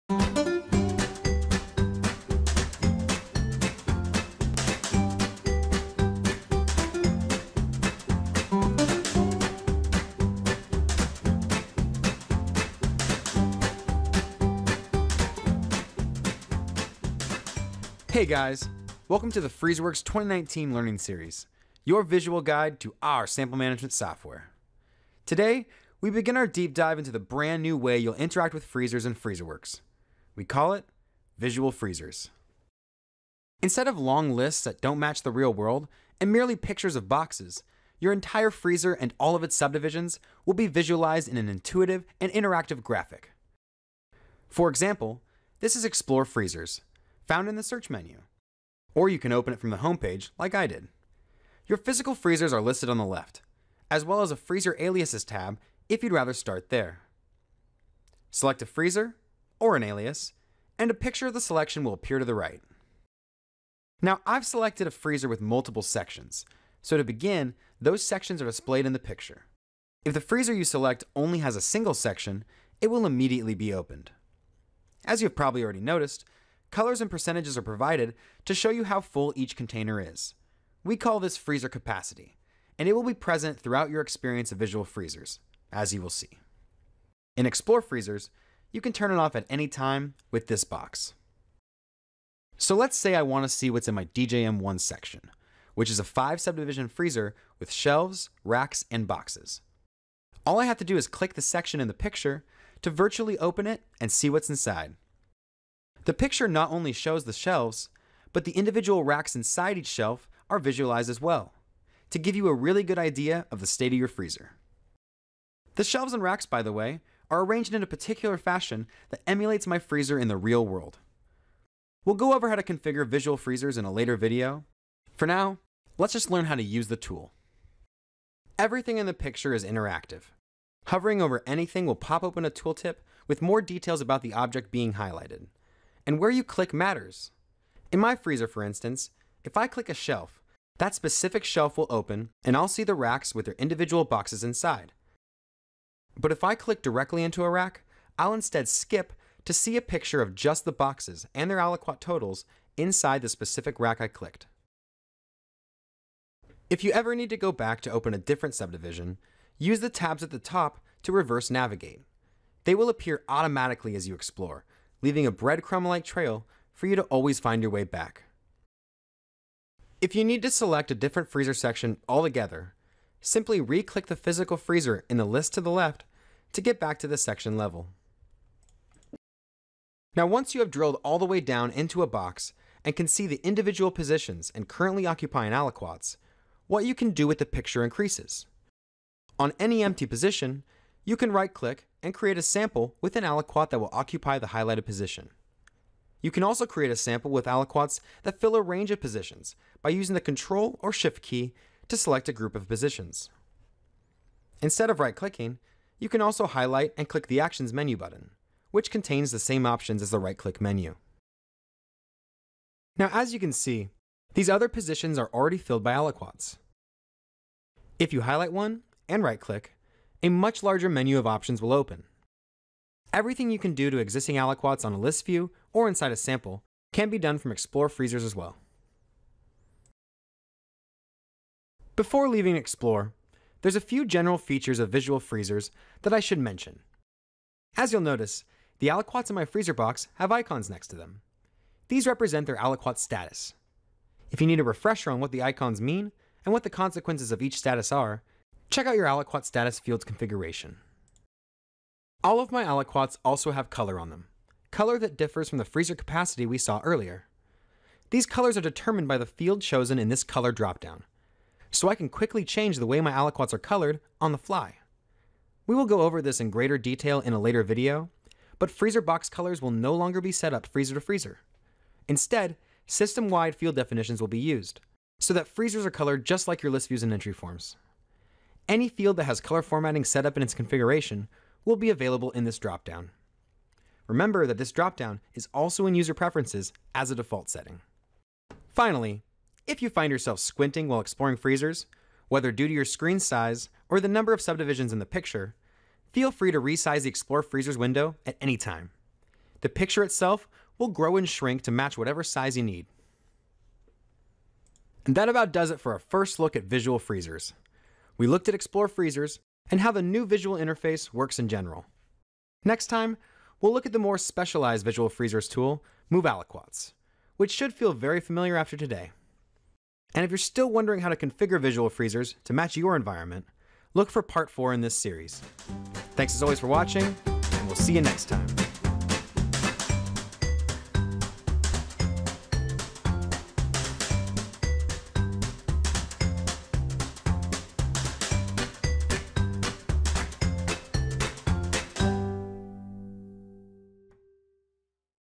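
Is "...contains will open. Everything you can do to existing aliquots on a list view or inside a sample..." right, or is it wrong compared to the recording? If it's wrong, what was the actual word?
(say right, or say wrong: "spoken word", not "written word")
wrong: "options", not "contains".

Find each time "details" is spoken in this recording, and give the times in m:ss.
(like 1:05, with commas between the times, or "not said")
2:13, 4:26.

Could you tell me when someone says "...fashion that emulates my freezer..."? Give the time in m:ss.
1:58.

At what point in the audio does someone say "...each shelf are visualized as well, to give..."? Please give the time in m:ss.
1:49.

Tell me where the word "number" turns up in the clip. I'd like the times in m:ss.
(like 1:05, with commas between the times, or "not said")
4:54.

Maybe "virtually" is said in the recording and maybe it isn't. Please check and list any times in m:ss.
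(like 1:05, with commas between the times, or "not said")
1:42.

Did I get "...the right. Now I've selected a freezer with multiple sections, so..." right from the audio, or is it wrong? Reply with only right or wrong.
right.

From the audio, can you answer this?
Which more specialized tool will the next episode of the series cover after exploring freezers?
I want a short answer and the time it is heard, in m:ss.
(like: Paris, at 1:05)
Move Aliquots, at 5:16.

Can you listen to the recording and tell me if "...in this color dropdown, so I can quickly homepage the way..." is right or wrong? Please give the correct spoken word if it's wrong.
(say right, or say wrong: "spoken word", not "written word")
wrong: "change", not "homepage".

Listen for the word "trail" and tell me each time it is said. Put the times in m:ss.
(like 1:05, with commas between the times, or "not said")
2:46.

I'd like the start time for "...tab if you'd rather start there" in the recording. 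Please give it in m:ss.
0:55.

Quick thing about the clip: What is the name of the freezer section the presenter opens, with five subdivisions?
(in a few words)
DJM1.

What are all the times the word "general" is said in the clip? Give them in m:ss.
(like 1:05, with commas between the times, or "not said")
3:54, 5:11.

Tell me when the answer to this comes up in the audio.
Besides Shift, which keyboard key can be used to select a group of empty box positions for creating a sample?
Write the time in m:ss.
3:20.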